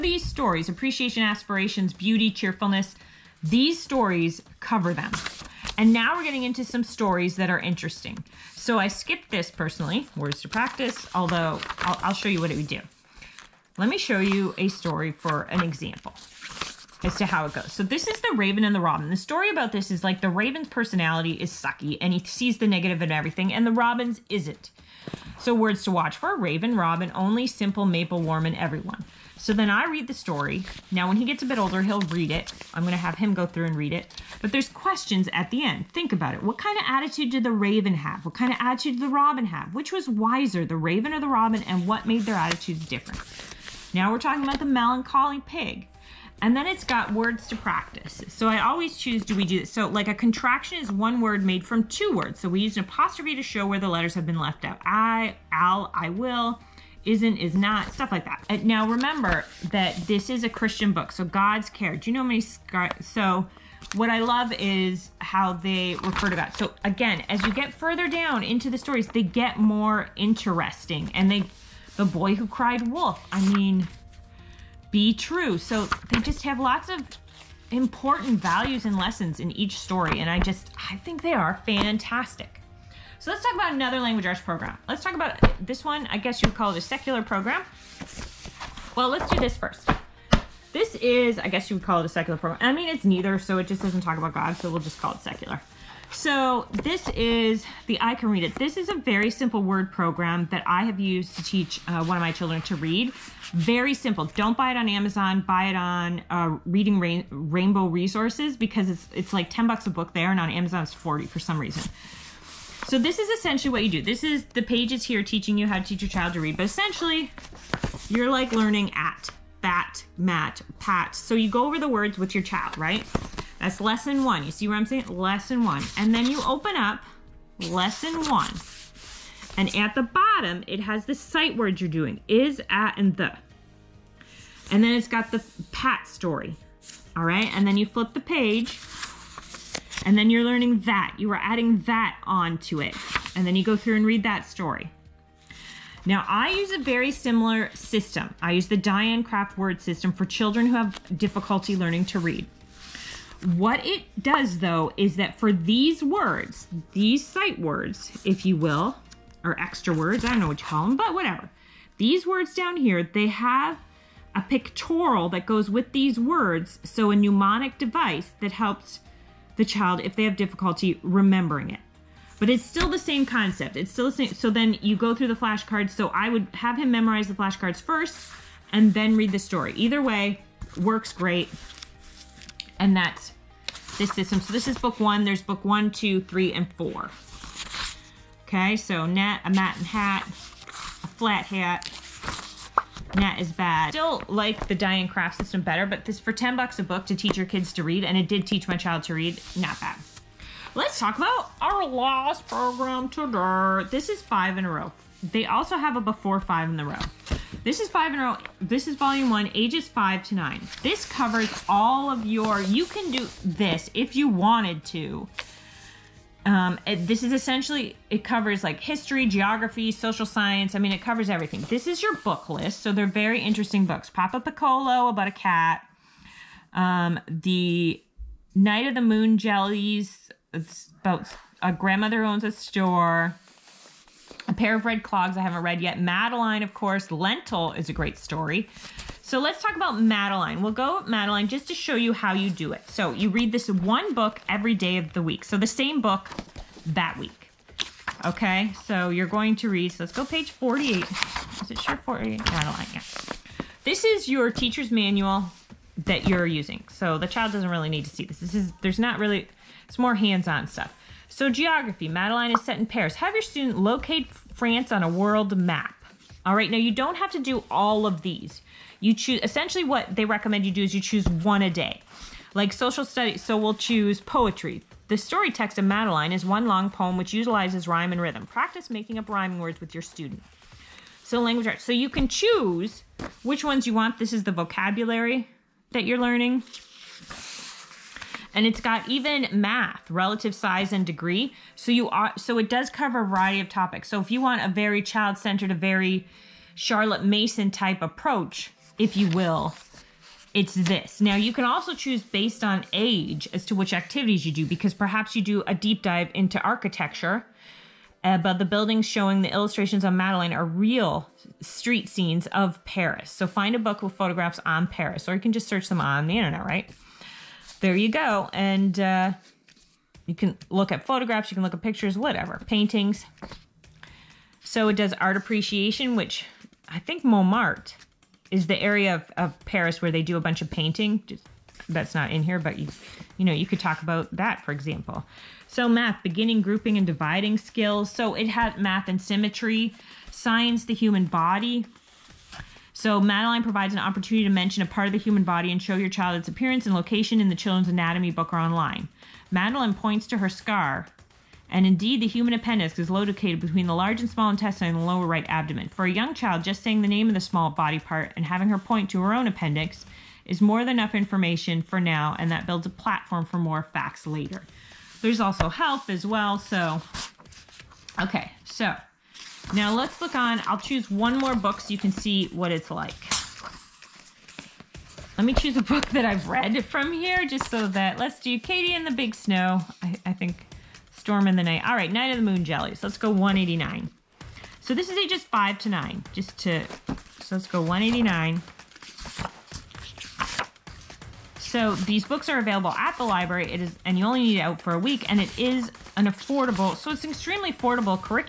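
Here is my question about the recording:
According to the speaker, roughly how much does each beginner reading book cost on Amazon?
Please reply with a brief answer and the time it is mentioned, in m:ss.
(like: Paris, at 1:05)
40, at 1:50.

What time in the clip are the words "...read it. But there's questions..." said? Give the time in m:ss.
0:33.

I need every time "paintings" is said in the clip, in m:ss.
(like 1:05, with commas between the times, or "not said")
5:22, 5:30.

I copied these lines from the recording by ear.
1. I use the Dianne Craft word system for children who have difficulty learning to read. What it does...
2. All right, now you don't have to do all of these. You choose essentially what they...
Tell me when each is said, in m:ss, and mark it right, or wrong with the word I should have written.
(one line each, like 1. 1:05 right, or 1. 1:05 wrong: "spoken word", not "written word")
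1. 2:28 right
2. 4:26 right.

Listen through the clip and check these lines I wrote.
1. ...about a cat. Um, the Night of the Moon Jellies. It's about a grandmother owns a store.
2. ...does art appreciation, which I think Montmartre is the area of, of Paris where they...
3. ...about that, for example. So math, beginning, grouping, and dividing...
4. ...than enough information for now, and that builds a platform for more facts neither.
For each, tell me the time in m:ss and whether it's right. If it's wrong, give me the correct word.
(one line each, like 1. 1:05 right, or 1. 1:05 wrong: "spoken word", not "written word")
1. 3:45 right
2. 5:24 right
3. 5:34 right
4. 6:00 wrong: "later", not "neither".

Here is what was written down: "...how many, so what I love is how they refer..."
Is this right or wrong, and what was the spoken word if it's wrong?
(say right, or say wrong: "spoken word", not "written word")
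right.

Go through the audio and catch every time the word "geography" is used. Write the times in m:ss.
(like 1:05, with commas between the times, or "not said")
3:39, 4:21.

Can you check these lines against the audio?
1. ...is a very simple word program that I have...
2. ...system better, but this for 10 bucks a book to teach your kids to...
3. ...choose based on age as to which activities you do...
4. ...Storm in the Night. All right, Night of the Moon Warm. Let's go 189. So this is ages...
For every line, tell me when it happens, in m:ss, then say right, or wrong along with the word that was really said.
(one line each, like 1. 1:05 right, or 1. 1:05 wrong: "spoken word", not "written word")
1. 1:38 right
2. 3:15 right
3. 5:01 right
4. 6:21 wrong: "Jellies", not "Warm".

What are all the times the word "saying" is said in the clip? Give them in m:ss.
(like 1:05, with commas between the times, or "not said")
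2:04, 5:56.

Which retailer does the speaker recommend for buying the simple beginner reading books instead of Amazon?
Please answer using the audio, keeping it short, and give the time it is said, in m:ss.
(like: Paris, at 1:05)
Rainbow Resources, at 1:47.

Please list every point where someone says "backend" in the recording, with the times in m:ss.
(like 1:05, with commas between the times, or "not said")
not said.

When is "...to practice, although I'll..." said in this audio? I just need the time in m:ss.
0:10.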